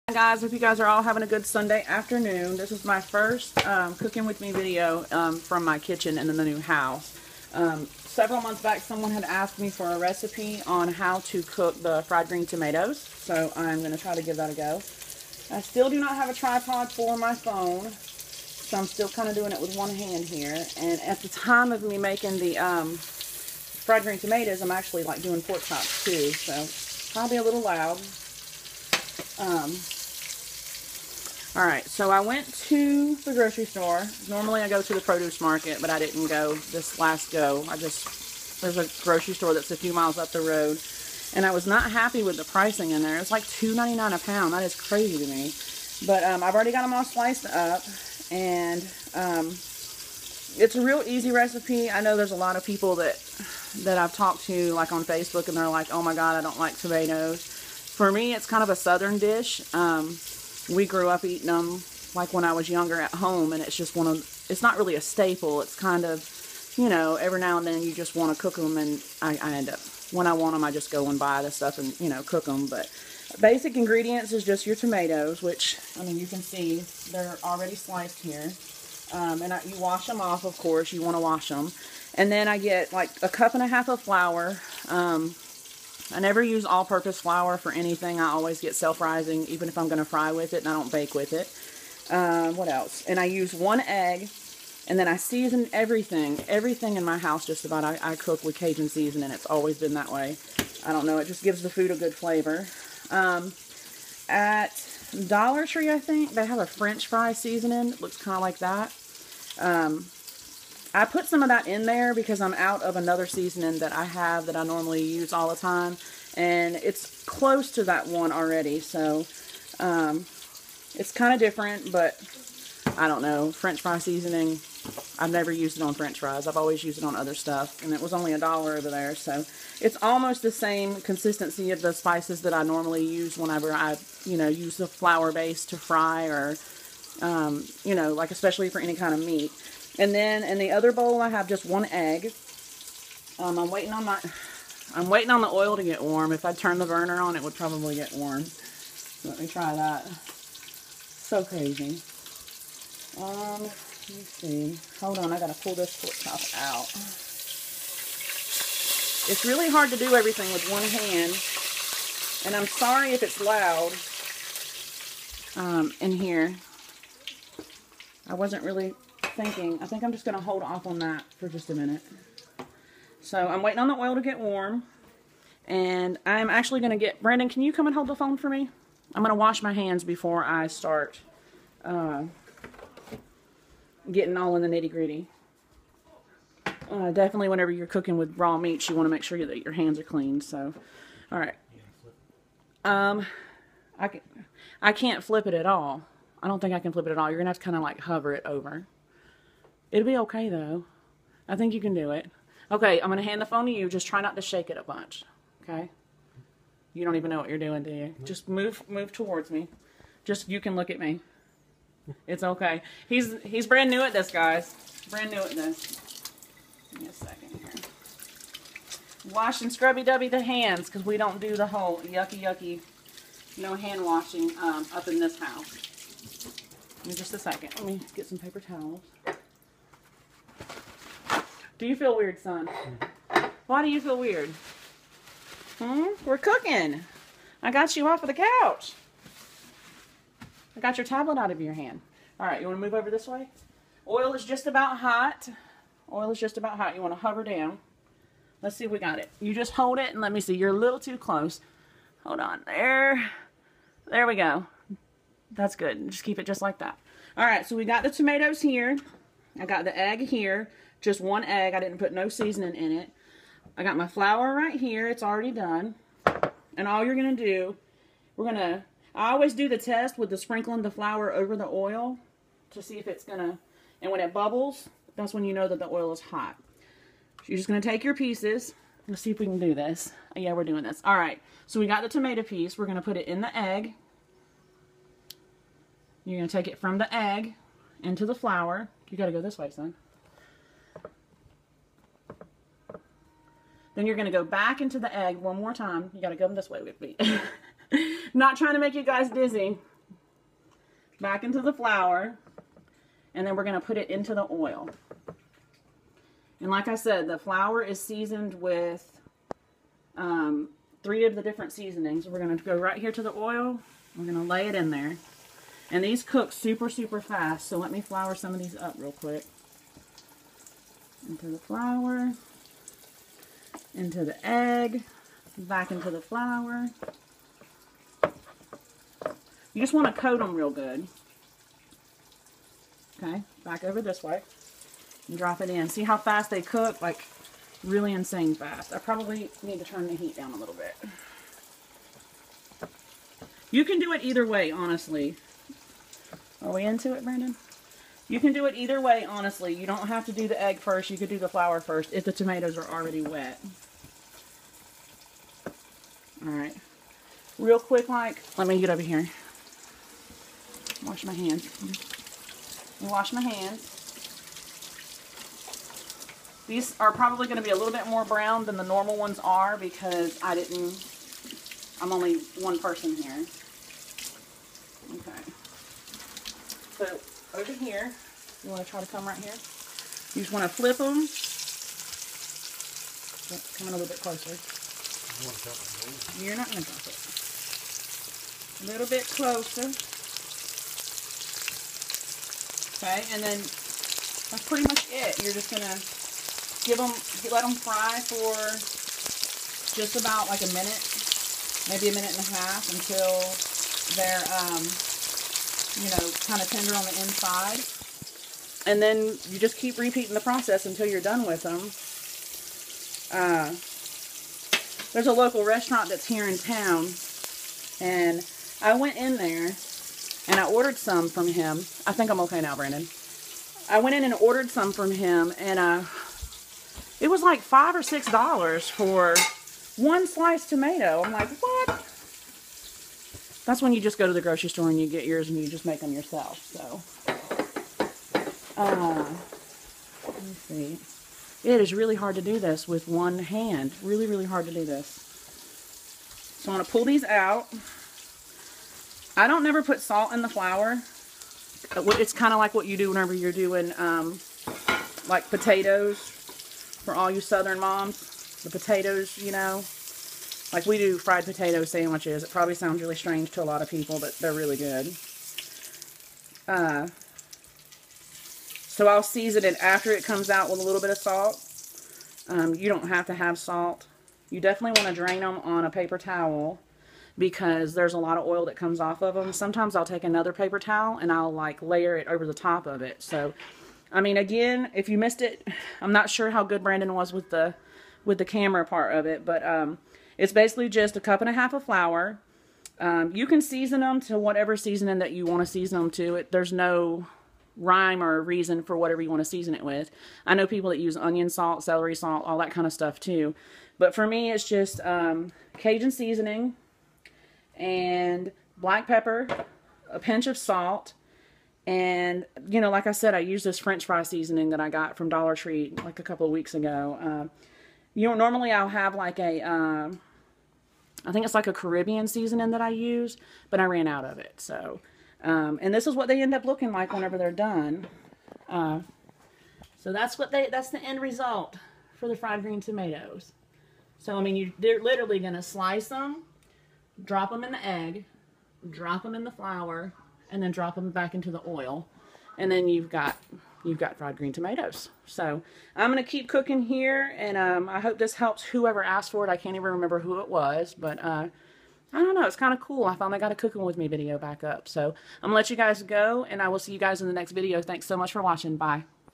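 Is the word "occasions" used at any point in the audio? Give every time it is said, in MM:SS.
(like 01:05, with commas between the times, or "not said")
not said.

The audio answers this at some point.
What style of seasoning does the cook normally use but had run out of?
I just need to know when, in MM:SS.
08:41.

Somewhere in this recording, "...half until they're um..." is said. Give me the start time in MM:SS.
06:42.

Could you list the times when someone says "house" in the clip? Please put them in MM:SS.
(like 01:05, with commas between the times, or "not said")
00:06, 01:37, 03:45.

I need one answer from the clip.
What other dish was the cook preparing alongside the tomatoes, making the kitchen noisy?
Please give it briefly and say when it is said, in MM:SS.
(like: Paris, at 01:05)
pork chops, at 00:25.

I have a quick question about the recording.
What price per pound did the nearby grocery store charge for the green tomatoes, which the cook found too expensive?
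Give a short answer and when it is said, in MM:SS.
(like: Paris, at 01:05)
$2.99, at 00:43.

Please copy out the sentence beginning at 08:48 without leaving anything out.
Uh, so that's what they, that's the end result for the fried green tomatoes.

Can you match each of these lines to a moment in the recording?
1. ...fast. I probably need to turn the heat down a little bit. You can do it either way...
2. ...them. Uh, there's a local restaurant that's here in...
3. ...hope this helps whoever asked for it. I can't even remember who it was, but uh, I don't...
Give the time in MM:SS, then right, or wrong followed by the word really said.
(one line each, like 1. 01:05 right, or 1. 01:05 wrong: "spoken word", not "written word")
1. 05:38 right
2. 06:51 right
3. 09:07 right.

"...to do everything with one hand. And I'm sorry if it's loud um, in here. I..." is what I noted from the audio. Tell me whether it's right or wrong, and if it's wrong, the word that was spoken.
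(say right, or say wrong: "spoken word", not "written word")
right.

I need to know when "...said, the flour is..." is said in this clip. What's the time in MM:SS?
05:06.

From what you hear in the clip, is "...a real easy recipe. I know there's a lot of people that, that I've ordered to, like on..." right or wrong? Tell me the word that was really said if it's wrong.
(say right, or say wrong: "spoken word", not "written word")
wrong: "talked", not "ordered".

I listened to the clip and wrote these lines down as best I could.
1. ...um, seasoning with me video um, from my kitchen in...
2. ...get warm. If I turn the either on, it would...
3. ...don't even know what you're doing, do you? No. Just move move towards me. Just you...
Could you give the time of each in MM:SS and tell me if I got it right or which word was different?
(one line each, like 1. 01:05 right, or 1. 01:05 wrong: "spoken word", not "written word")
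1. 00:03 wrong: "cooking", not "seasoning"
2. 02:25 wrong: "burner", not "either"
3. 03:27 right.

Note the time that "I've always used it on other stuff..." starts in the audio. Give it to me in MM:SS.
02:06.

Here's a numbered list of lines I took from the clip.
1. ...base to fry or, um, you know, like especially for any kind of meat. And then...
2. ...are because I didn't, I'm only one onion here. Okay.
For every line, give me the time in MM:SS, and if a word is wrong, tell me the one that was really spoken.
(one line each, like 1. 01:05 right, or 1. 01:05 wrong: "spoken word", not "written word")
1. 02:15 right
2. 06:09 wrong: "person", not "onion".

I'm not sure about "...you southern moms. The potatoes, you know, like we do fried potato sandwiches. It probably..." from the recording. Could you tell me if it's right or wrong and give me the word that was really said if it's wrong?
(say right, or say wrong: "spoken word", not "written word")
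right.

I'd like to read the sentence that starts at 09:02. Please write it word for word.
And then you've got you've got fried green tomatoes.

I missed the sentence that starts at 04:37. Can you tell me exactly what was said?
So you're just going to take your pieces.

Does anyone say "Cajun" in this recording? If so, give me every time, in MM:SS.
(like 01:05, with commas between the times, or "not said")
01:38, 08:25.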